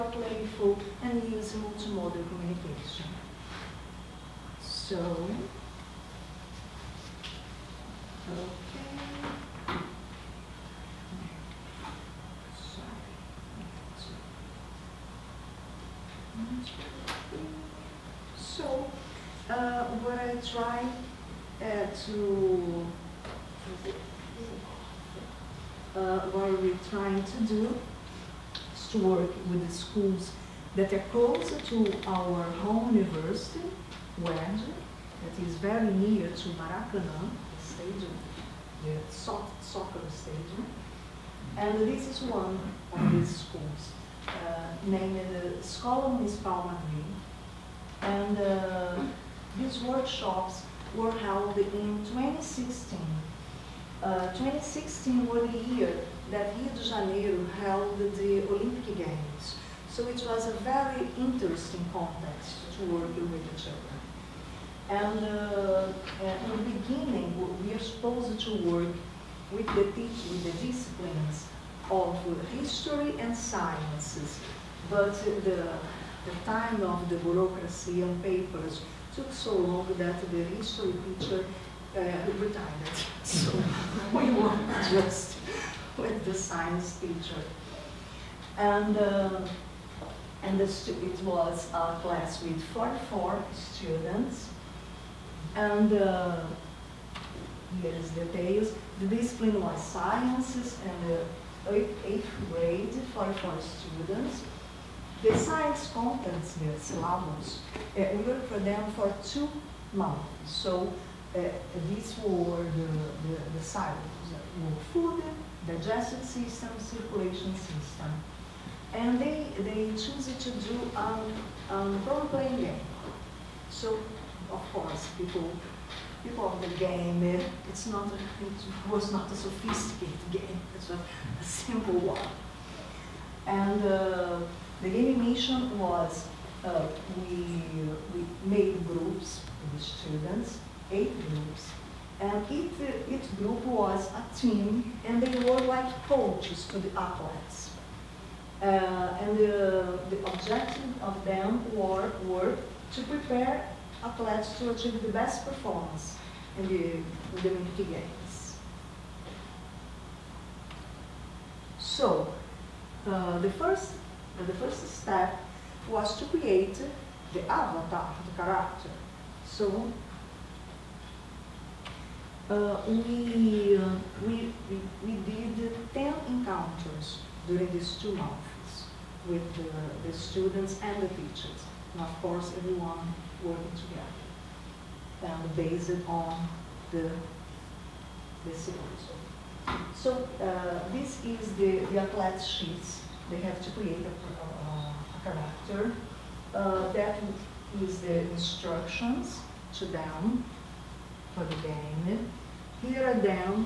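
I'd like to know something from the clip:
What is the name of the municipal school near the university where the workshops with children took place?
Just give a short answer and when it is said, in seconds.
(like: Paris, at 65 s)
Escola Municipal Madrid, at 46 s.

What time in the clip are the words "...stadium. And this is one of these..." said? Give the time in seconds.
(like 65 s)
40 s.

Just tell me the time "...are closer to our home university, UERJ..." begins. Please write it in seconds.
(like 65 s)
30 s.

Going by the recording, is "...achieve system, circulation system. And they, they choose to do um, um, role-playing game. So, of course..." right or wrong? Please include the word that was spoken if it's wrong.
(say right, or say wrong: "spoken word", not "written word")
wrong: "digestive", not "achieve".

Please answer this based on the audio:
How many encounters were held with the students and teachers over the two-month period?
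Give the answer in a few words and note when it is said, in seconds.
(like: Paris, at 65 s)
10, at 175 s.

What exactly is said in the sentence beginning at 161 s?
So, uh, the, first, uh, the first step was to create the avatar, the character.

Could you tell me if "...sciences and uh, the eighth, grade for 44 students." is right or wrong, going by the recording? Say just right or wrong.
right.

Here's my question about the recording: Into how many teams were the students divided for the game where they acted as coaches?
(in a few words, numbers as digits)
8.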